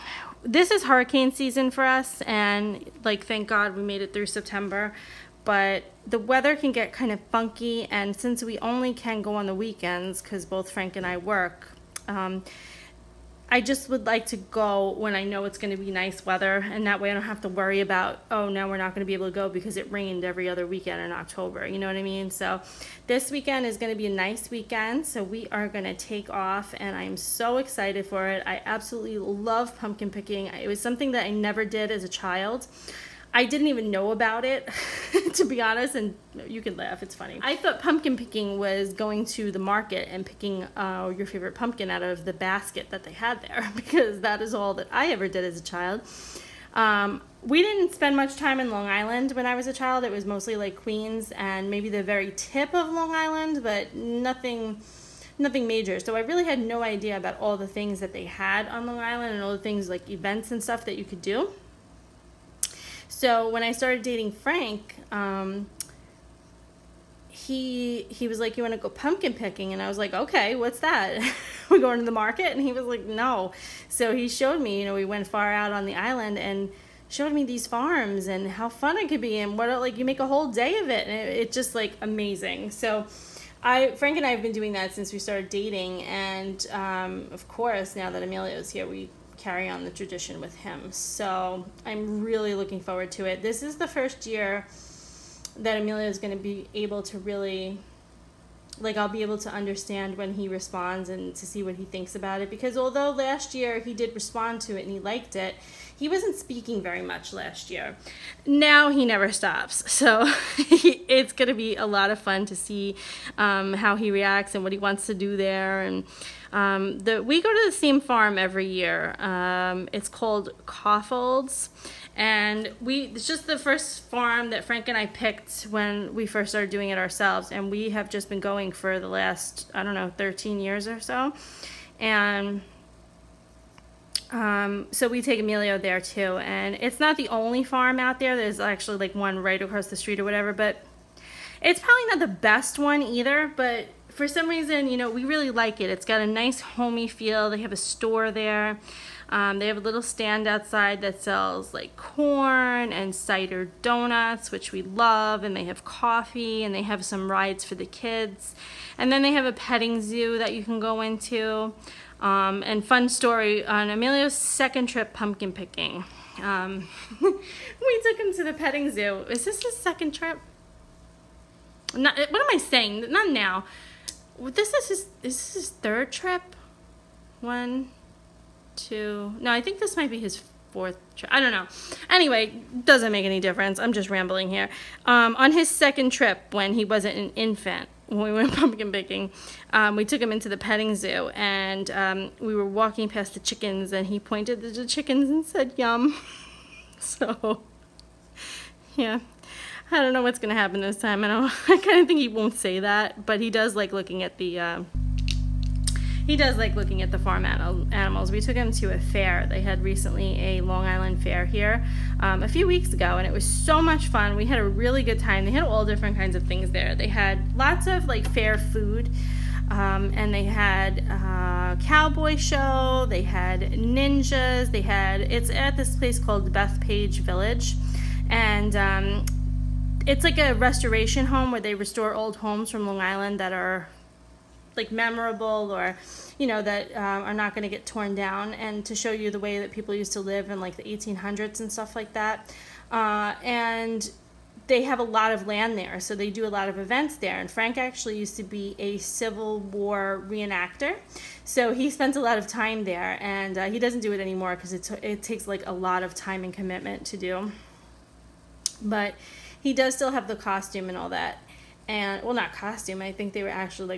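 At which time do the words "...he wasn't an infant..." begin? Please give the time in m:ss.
3:06.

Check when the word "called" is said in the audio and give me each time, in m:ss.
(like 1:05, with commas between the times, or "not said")
2:00, 3:46.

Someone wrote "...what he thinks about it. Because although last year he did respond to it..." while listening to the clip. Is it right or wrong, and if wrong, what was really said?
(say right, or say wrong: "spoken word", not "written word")
right.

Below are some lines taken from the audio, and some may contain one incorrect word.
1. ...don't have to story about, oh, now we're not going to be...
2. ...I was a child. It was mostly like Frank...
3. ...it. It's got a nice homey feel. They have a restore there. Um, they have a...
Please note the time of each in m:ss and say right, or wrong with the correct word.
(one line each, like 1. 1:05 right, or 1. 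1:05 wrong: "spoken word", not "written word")
1. 0:17 wrong: "worry", not "story"
2. 0:49 wrong: "Queens", not "Frank"
3. 2:25 wrong: "store", not "restore".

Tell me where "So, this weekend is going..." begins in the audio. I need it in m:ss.
0:22.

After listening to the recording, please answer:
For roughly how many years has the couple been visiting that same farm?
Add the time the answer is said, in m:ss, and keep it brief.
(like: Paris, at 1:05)
13, at 2:10.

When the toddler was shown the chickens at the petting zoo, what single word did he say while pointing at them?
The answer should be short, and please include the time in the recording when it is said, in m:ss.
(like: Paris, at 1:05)
yum, at 3:15.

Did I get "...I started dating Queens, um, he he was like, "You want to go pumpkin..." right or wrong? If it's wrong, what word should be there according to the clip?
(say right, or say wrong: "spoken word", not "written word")
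wrong: "Frank", not "Queens".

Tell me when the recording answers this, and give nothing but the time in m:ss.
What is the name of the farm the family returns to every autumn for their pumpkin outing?
2:00.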